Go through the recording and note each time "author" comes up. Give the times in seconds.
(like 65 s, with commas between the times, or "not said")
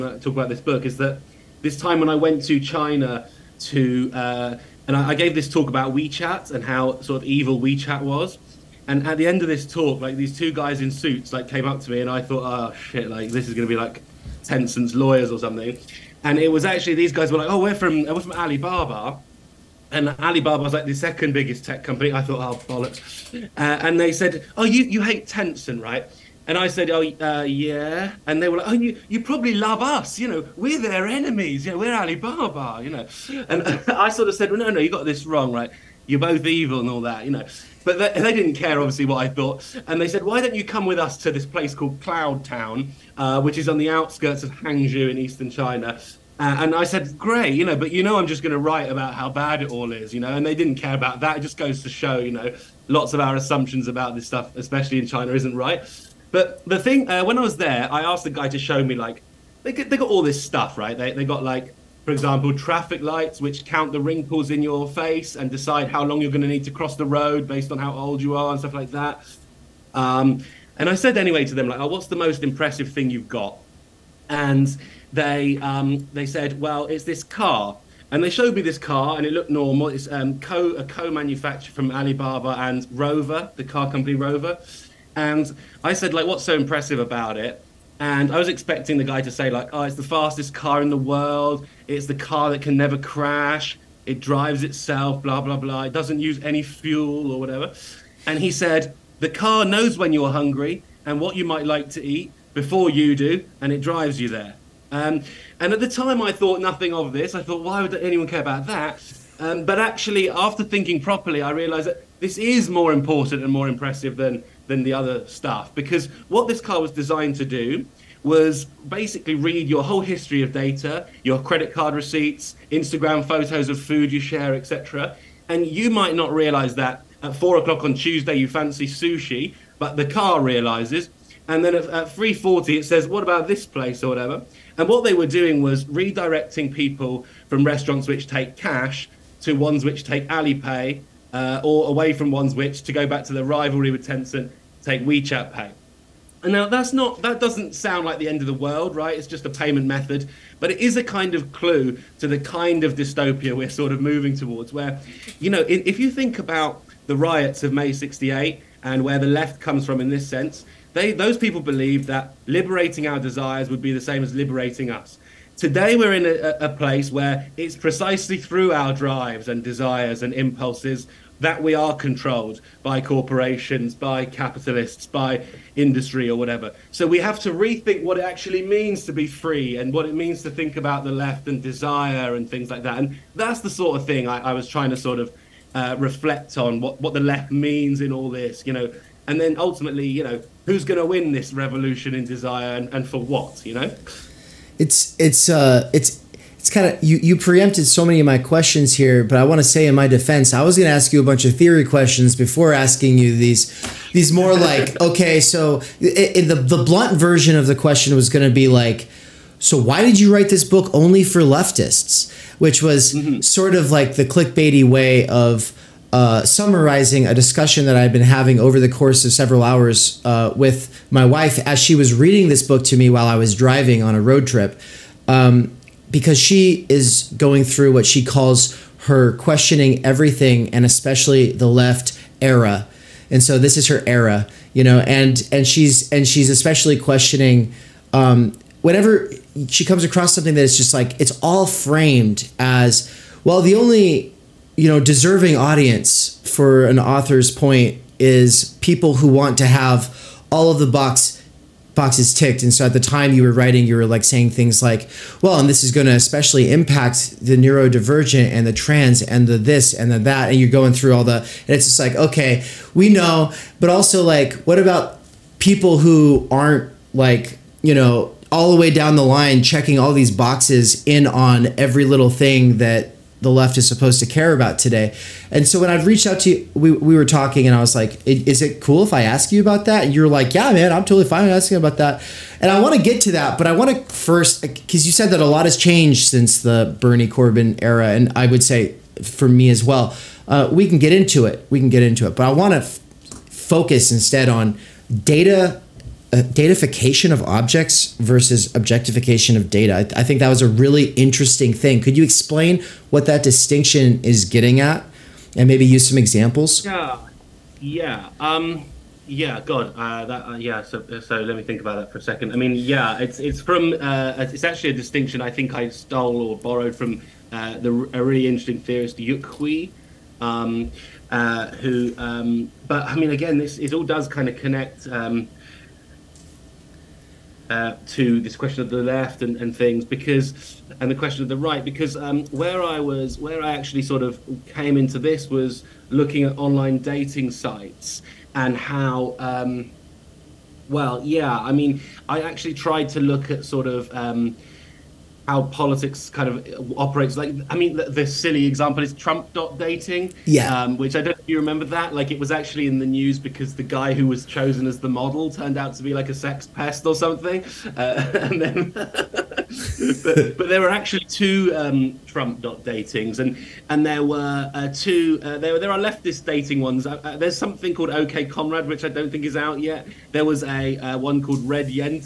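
246 s.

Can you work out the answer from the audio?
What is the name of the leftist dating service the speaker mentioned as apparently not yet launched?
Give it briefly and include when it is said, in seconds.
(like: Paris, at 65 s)
OK Comrade, at 368 s.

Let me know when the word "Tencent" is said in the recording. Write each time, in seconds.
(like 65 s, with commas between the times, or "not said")
14 s, 25 s, 144 s.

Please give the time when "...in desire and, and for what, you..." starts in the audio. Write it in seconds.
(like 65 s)
192 s.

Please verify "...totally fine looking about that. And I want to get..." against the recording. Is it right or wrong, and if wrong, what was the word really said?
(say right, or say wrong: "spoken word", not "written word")
wrong: "asking", not "looking".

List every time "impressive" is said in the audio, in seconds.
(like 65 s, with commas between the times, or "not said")
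72 s, 86 s, 113 s.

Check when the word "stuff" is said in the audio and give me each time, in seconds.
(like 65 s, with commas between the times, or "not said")
54 s, 60 s, 68 s, 115 s.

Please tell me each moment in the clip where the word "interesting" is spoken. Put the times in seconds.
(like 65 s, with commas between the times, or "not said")
301 s, 318 s.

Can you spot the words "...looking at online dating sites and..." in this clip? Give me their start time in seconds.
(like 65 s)
336 s.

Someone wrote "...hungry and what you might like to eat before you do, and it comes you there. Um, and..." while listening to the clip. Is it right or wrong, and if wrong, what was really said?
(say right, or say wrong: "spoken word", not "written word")
wrong: "drives", not "comes".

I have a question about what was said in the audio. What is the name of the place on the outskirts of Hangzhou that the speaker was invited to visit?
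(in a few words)
Cloud Town.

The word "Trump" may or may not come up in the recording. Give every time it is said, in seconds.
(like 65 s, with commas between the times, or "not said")
349 s, 362 s.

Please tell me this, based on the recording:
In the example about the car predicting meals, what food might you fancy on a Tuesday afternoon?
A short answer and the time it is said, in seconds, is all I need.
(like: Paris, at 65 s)
sushi, at 128 s.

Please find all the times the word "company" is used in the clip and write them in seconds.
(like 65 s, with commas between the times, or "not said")
21 s, 83 s.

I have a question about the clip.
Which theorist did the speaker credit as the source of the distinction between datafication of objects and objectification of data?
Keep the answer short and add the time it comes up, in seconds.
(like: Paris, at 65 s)
Yuk Hui, at 319 s.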